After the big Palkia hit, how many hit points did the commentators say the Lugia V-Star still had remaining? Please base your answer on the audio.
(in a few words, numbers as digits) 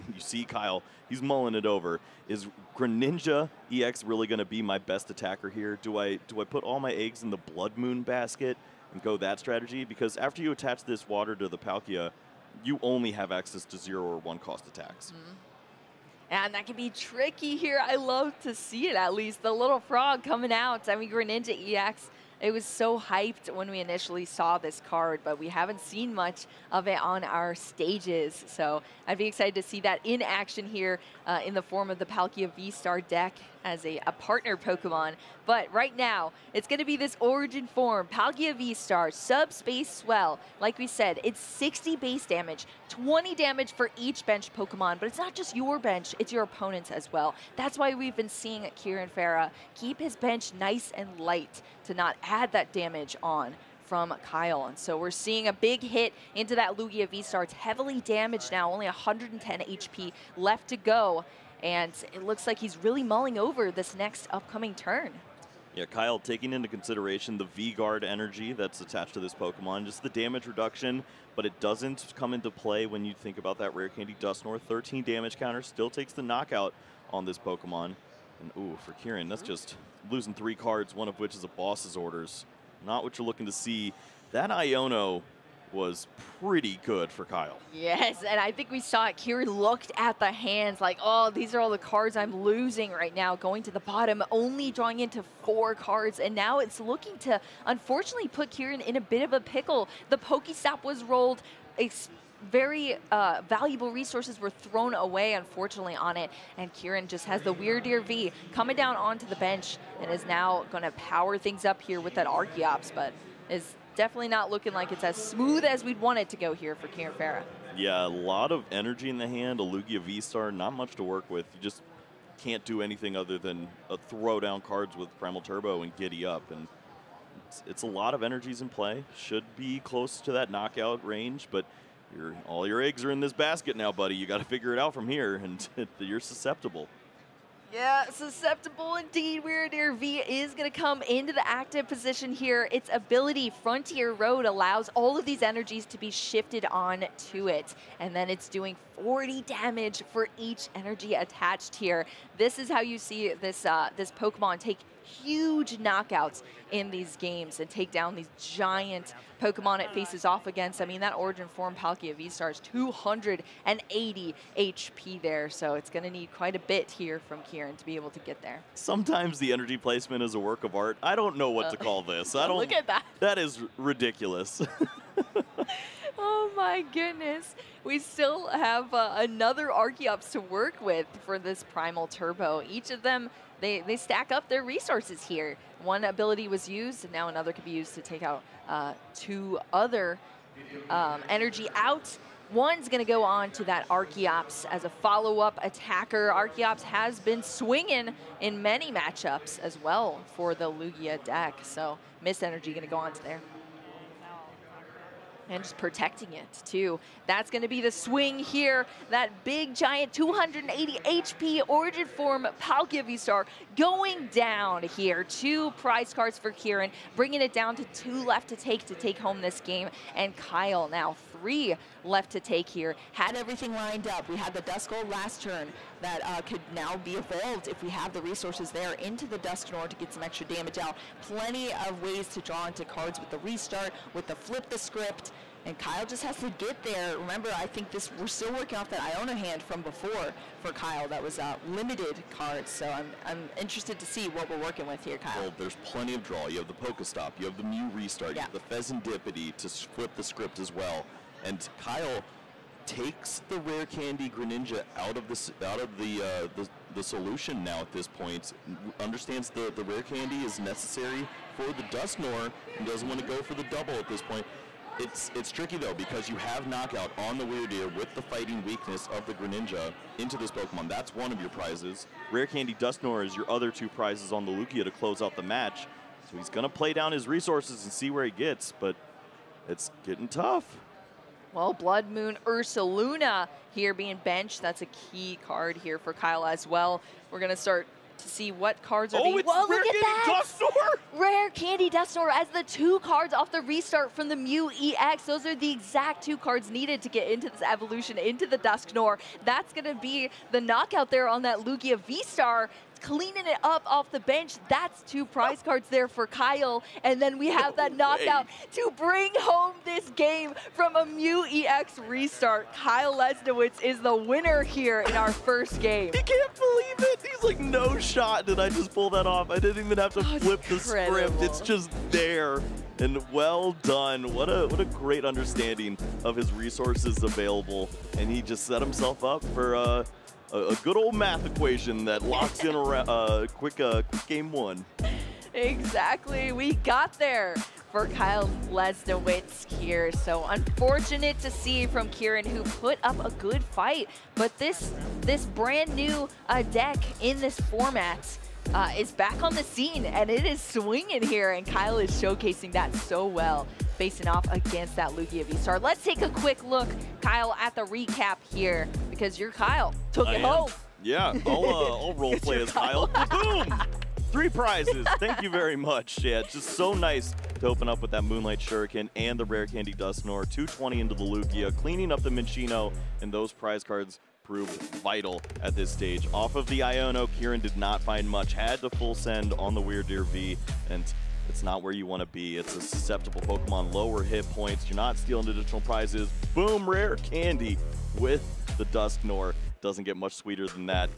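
110.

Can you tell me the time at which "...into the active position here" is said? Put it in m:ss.
2:21.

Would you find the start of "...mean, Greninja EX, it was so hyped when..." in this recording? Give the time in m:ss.
0:20.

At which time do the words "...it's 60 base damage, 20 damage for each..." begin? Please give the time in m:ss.
0:41.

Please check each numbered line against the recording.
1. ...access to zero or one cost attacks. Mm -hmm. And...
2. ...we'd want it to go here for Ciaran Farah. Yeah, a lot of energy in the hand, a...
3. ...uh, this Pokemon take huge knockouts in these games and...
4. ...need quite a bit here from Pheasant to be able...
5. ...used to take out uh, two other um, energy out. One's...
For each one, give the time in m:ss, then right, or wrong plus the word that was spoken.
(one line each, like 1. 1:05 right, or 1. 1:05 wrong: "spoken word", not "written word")
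1. 0:13 right
2. 1:55 right
3. 2:33 right
4. 2:46 wrong: "Ciaran", not "Pheasant"
5. 3:07 right.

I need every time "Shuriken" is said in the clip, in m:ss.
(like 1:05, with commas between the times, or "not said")
6:08.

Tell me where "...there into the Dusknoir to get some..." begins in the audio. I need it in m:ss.
3:48.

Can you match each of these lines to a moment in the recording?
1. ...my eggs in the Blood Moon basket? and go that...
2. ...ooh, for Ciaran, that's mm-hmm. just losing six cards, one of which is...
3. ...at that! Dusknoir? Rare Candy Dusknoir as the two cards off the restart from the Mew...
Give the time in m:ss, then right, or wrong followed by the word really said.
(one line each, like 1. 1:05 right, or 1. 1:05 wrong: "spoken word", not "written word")
1. 0:06 right
2. 1:18 wrong: "three", not "six"
3. 4:49 right.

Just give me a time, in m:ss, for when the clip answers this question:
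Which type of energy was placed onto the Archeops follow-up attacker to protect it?
3:22.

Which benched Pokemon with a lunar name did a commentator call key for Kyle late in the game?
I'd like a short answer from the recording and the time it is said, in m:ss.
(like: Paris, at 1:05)
Blood Moon Ursaluna, at 4:41.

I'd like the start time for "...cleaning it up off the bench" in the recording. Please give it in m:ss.
5:02.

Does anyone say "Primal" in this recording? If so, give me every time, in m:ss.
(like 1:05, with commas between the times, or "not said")
2:05, 3:01.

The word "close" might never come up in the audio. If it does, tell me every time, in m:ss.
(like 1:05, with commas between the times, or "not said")
2:09, 4:34.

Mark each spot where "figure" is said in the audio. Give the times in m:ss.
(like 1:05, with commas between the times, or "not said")
2:14.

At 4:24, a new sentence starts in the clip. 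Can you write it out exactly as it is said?
It's it's tricky though because you have knockout on the Wyrdeer with the fighting weakness of the Greninja into this Pokemon.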